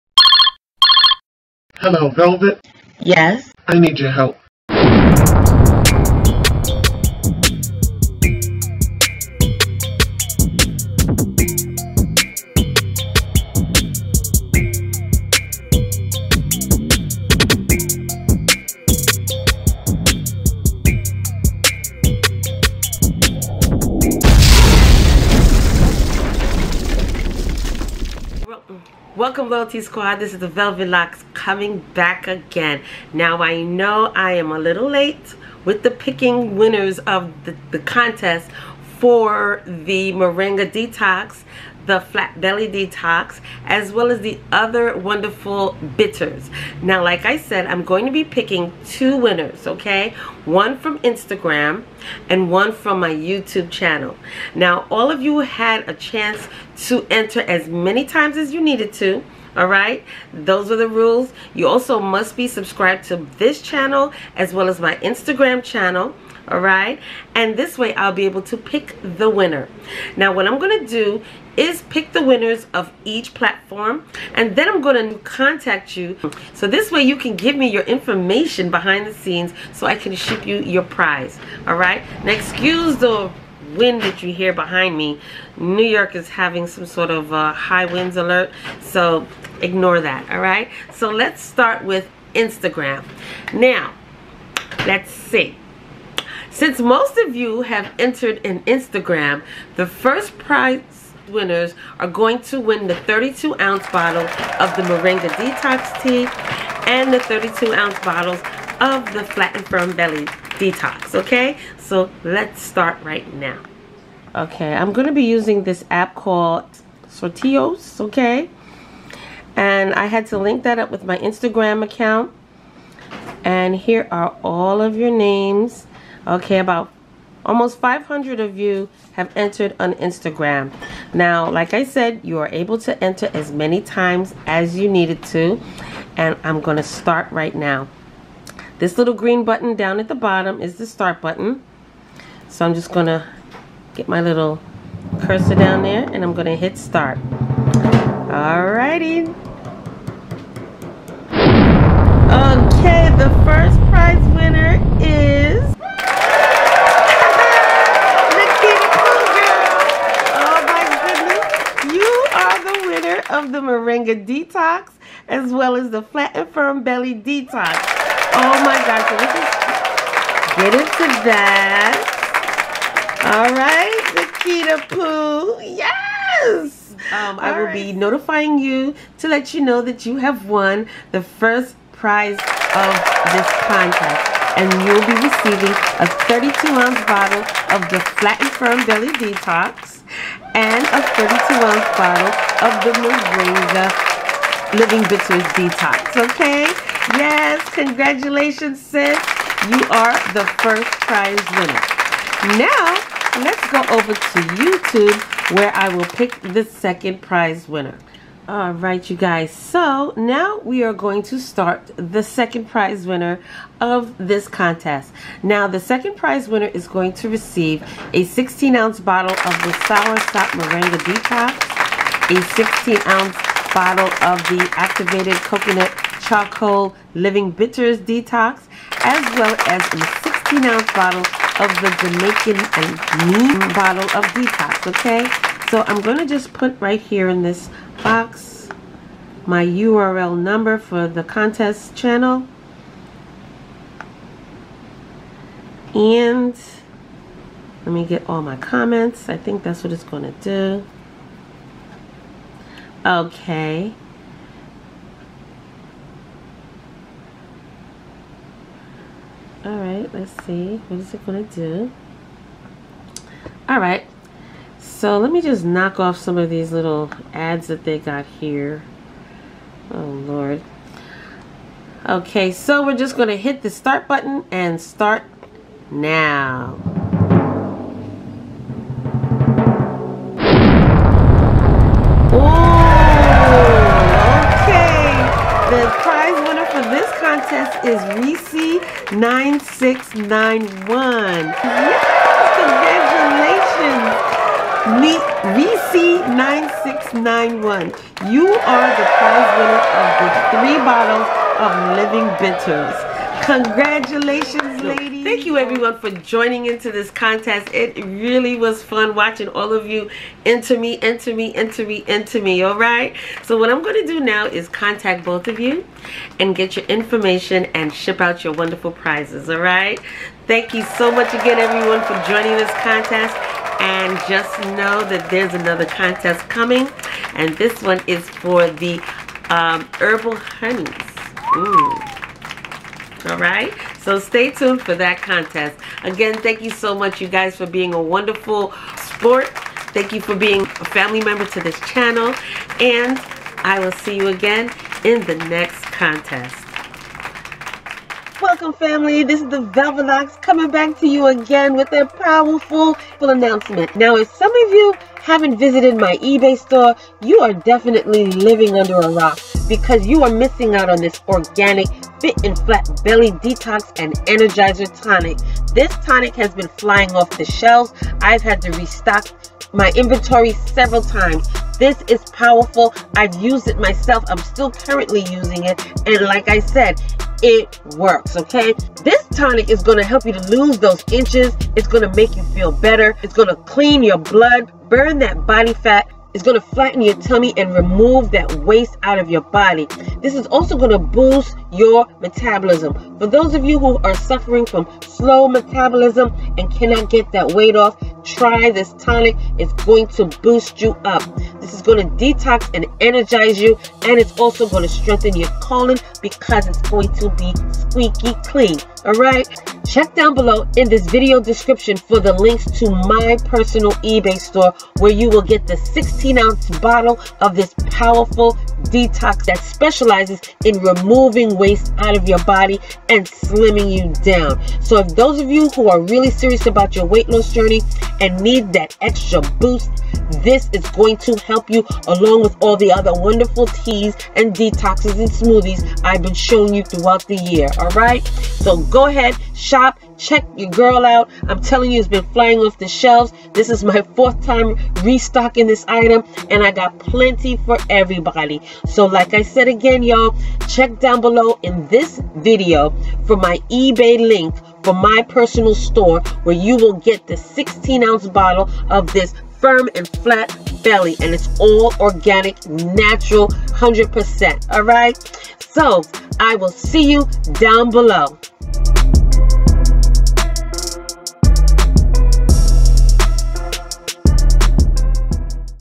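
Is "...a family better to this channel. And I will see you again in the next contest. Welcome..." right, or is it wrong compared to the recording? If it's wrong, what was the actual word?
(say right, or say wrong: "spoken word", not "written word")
wrong: "member", not "better".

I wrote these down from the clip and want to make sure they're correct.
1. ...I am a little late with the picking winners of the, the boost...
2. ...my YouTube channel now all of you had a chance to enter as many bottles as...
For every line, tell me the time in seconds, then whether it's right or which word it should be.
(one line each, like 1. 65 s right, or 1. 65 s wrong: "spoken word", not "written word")
1. 34 s wrong: "contest", not "boost"
2. 52 s wrong: "times", not "bottles".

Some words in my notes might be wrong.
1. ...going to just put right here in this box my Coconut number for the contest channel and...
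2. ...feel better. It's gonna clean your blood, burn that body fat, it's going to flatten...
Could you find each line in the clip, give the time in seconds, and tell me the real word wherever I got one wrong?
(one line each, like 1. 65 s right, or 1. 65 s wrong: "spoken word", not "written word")
1. 236 s wrong: "URL", not "Coconut"
2. 382 s right.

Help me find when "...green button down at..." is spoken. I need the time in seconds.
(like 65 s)
139 s.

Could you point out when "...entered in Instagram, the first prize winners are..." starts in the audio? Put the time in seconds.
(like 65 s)
97 s.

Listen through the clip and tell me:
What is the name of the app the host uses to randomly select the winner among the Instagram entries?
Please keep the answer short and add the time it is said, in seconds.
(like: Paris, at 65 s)
Sorteos, at 117 s.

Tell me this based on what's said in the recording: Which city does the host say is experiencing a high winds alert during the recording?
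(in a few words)
New York.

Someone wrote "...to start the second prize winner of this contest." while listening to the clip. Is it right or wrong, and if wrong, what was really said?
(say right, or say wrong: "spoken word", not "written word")
right.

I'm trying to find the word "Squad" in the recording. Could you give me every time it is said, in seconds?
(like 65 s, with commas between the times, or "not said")
29 s.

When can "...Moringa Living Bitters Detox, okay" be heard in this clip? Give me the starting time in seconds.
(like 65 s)
192 s.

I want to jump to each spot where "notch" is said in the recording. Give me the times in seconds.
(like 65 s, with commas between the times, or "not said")
not said.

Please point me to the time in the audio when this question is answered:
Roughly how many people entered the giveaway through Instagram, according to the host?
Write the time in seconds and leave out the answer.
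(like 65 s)
127 s.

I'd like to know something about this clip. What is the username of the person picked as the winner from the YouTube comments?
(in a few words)
Reese9691.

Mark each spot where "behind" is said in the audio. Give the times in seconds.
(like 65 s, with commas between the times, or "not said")
78 s, 84 s.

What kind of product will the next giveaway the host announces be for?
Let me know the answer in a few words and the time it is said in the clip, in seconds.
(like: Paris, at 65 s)
herbal honeys, at 329 s.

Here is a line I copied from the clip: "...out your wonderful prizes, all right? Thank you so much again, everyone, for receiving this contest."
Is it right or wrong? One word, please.
wrong.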